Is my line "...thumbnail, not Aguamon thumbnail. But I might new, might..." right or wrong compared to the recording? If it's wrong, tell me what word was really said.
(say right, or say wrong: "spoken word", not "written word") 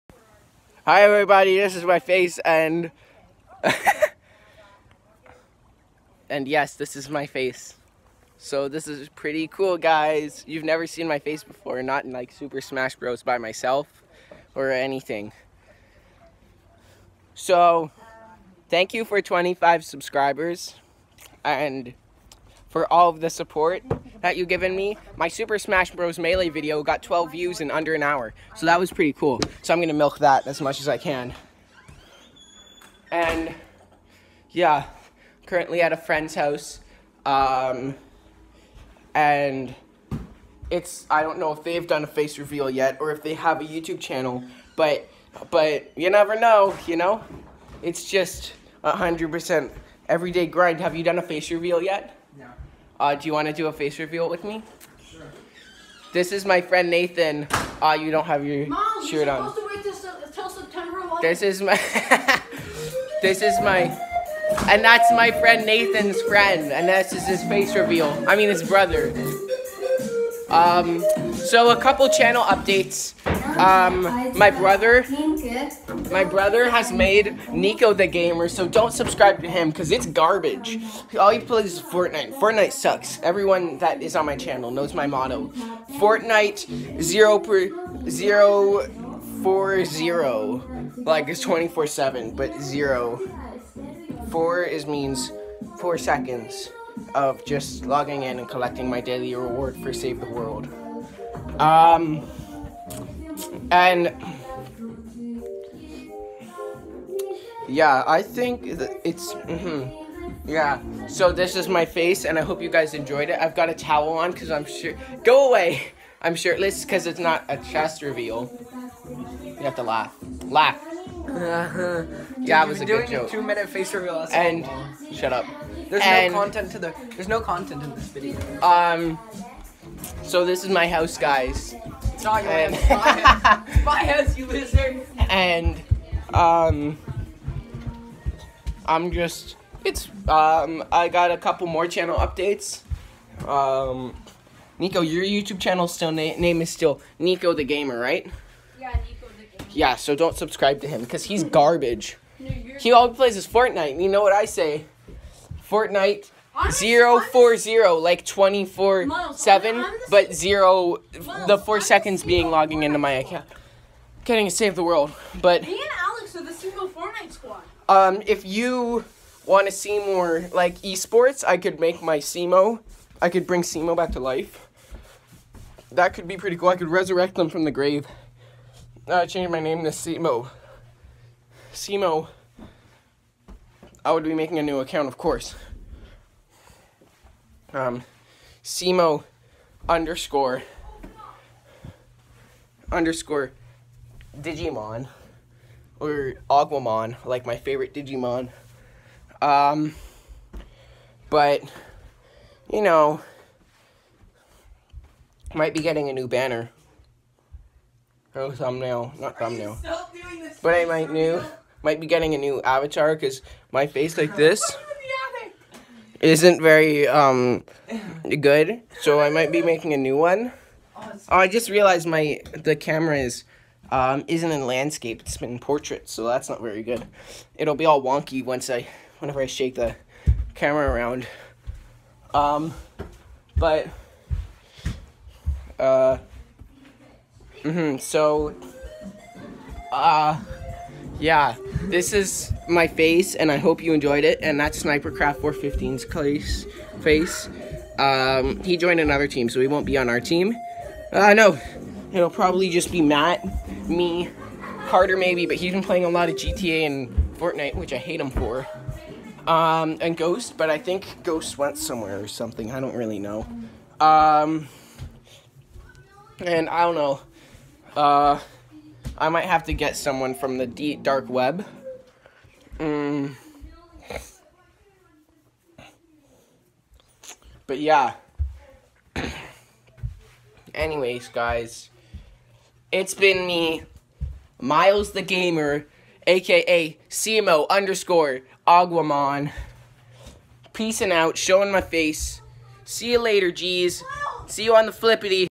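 wrong: "Are", not "Aguamon".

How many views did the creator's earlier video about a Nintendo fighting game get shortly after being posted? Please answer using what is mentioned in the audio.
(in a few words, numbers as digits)
12.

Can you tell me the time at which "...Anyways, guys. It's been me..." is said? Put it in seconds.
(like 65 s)
280 s.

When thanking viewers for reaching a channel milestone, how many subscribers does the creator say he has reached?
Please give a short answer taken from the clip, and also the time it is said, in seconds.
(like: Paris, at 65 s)
25, at 19 s.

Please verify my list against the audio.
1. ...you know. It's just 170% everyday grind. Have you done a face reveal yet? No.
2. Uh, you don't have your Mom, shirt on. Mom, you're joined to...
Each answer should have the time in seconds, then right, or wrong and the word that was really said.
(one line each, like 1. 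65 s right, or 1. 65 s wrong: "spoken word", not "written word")
1. 46 s wrong: "100", not "170"
2. 57 s wrong: "supposed", not "joined".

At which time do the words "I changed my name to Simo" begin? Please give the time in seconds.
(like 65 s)
179 s.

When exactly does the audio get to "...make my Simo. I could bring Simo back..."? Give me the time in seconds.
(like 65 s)
171 s.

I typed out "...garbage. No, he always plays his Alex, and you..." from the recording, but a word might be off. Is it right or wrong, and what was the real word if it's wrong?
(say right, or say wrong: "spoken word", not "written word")
wrong: "Fortnite", not "Alex".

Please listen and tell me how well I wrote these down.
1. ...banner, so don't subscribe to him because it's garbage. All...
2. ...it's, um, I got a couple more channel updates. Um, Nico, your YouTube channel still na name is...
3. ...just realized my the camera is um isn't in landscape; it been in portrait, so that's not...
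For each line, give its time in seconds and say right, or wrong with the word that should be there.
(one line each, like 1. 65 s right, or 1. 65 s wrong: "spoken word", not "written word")
1. 78 s wrong: "gamer", not "banner"
2. 139 s right
3. 221 s right.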